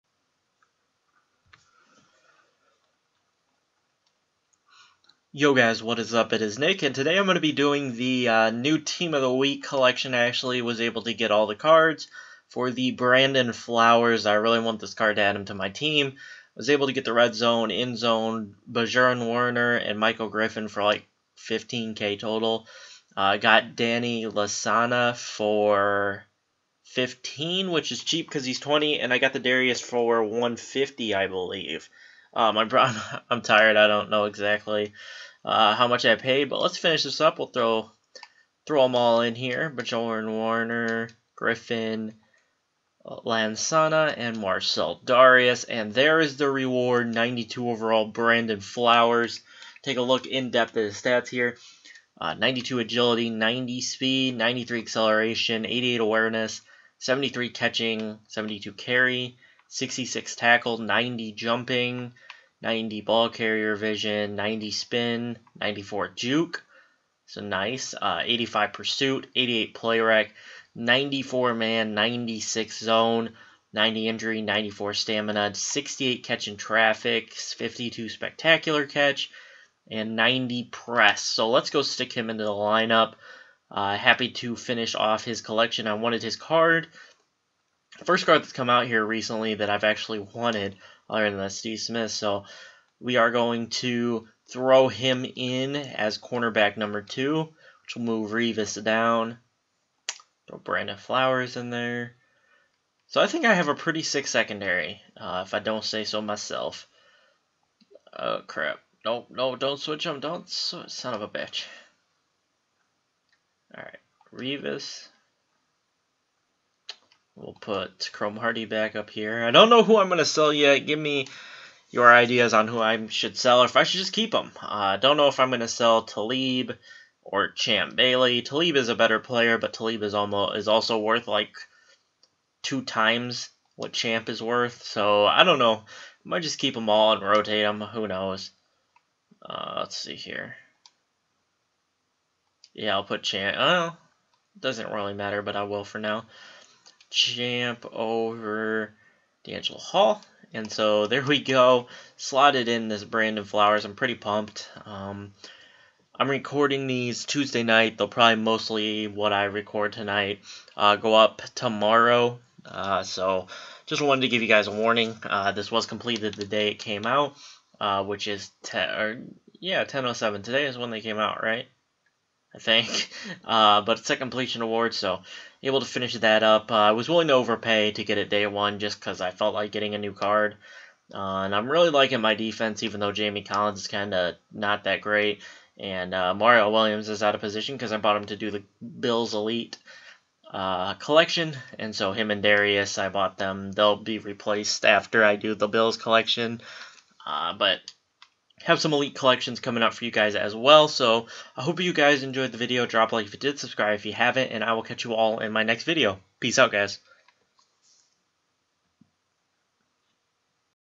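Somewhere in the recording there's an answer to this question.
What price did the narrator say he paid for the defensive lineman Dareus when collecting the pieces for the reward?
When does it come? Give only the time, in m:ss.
0:30.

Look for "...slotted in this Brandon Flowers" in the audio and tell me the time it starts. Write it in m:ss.
2:32.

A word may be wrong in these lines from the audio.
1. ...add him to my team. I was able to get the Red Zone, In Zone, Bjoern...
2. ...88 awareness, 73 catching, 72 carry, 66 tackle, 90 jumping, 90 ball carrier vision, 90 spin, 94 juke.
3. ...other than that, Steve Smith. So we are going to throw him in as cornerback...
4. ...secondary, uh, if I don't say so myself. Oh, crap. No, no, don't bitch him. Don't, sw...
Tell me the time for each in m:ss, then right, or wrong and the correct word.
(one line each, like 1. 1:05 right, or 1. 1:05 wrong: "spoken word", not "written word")
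1. 0:15 right
2. 0:55 right
3. 1:31 right
4. 1:44 wrong: "switch", not "bitch".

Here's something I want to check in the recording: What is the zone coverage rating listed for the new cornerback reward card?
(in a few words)
96.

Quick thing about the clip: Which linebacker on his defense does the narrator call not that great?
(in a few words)
Jamie Collins.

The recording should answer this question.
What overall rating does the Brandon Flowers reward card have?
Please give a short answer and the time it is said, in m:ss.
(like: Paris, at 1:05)
92, at 0:47.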